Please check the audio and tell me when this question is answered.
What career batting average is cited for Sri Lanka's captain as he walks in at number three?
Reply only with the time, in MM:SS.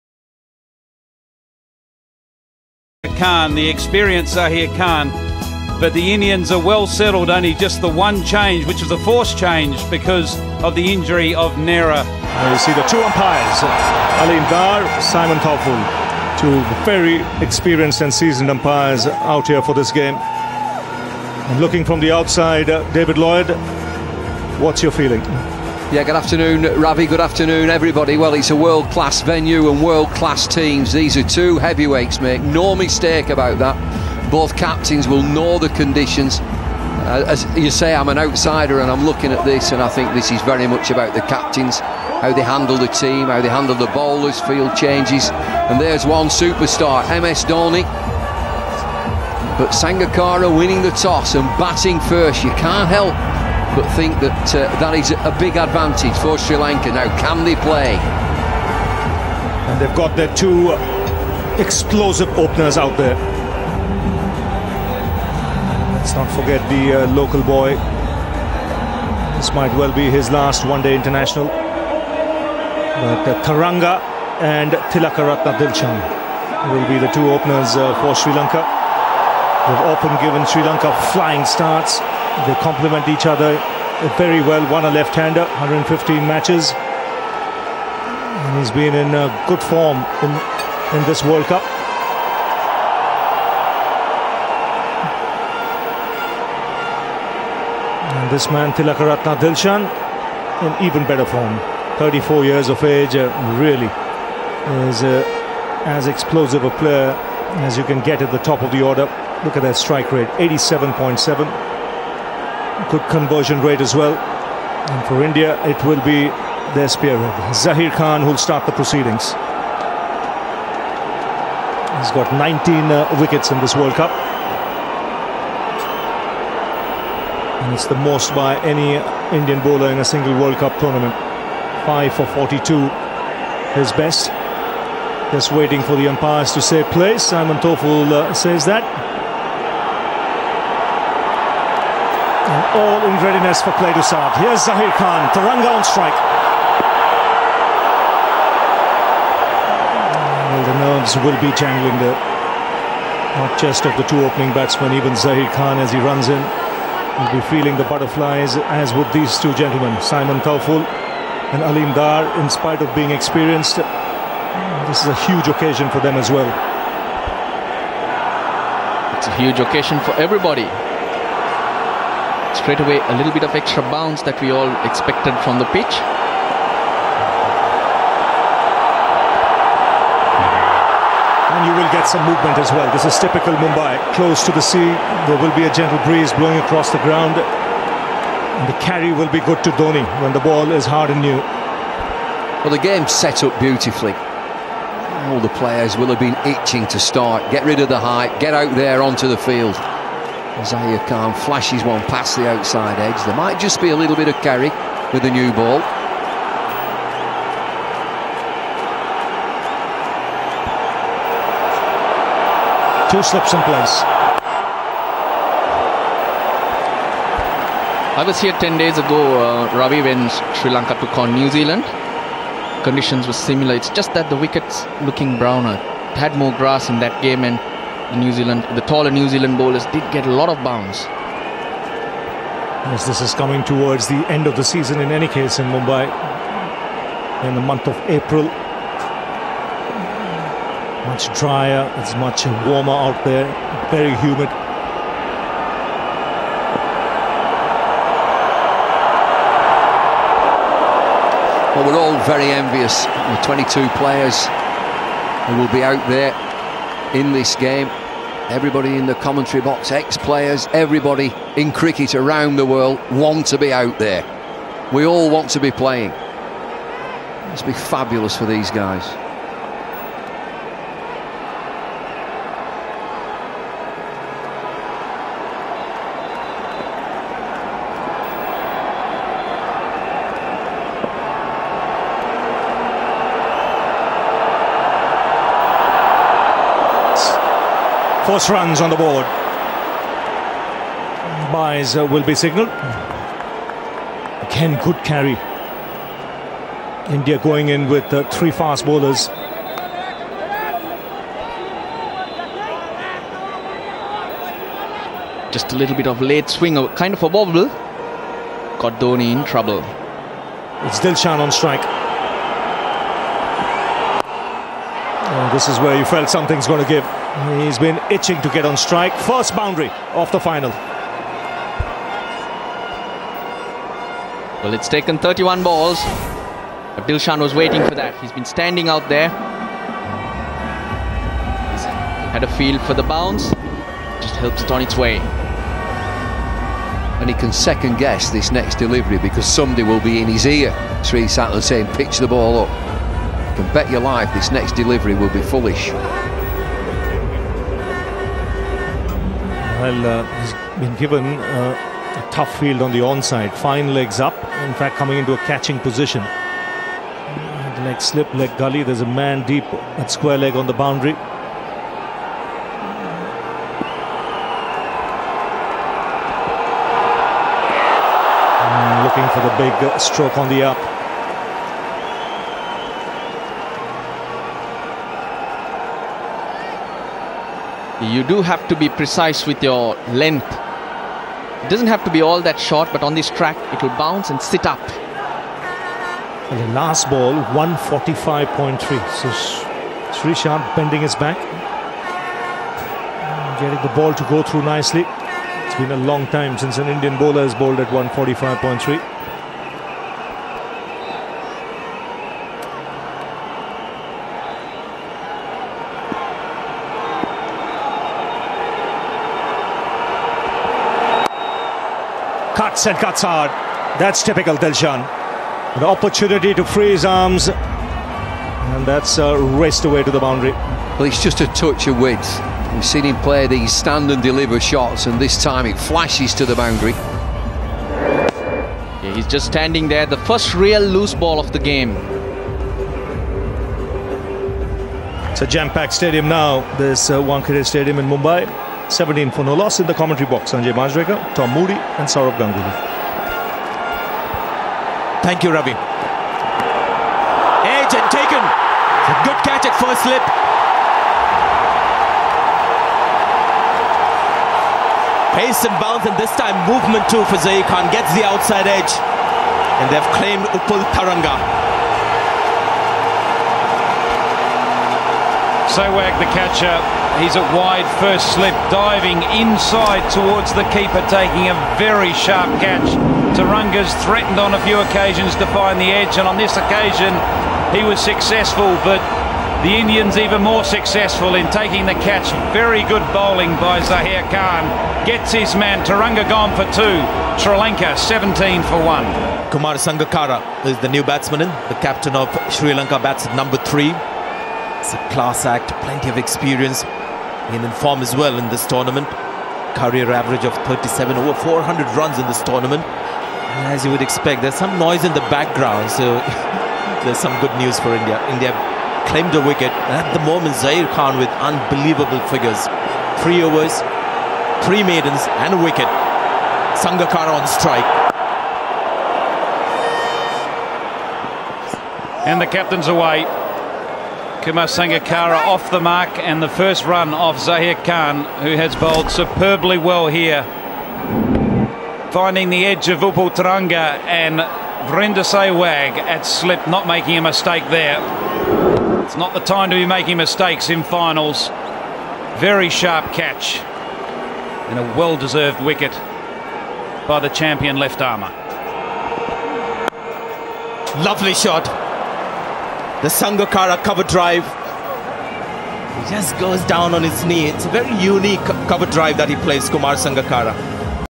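08:20.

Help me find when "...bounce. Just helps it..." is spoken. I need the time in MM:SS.
05:33.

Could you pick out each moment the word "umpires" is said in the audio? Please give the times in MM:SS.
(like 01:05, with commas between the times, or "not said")
00:13, 00:18, 02:16.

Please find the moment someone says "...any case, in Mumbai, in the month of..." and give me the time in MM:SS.
03:55.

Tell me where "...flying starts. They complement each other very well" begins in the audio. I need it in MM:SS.
01:21.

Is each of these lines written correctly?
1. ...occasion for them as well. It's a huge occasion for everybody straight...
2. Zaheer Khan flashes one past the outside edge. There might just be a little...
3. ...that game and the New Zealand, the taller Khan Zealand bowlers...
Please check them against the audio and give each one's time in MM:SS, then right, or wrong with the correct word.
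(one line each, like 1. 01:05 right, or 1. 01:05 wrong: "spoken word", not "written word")
1. 02:45 right
2. 03:20 right
3. 03:46 wrong: "New", not "Khan".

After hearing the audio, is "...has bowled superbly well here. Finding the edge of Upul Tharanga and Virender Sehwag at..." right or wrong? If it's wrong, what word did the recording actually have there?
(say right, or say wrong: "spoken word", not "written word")
right.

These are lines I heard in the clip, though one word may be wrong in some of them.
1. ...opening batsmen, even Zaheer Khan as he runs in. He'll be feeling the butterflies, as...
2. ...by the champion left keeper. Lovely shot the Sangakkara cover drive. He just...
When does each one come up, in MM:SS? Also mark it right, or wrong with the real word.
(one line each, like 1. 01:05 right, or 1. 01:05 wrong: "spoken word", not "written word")
1. 02:34 right
2. 09:07 wrong: "armer", not "keeper".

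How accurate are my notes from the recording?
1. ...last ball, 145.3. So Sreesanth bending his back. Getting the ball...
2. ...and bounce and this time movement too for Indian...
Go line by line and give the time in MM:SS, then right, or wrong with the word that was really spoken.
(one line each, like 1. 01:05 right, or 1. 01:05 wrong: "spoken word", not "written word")
1. 06:26 right
2. 07:35 wrong: "Zaheer", not "Indian".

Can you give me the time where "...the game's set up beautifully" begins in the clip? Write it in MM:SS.
03:12.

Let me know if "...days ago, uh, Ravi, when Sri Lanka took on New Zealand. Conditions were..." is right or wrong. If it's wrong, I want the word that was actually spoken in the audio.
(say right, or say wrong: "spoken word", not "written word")
right.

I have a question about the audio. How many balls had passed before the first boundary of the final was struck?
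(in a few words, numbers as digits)
31.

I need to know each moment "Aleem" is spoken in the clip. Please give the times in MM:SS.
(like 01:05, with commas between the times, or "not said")
00:14, 02:41.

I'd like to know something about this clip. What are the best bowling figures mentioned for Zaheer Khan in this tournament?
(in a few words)
5 for 42.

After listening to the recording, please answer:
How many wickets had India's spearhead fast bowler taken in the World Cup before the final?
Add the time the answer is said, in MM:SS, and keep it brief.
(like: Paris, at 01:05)
19, at 02:02.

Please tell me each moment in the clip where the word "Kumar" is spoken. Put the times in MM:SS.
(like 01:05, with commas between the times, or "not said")
08:09, 08:44, 09:19.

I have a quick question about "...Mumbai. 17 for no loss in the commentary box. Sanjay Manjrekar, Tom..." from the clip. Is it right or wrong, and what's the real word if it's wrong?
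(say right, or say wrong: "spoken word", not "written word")
right.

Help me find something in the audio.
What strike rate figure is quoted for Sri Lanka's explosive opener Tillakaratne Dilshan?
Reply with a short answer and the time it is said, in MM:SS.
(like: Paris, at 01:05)
87.7, at 01:50.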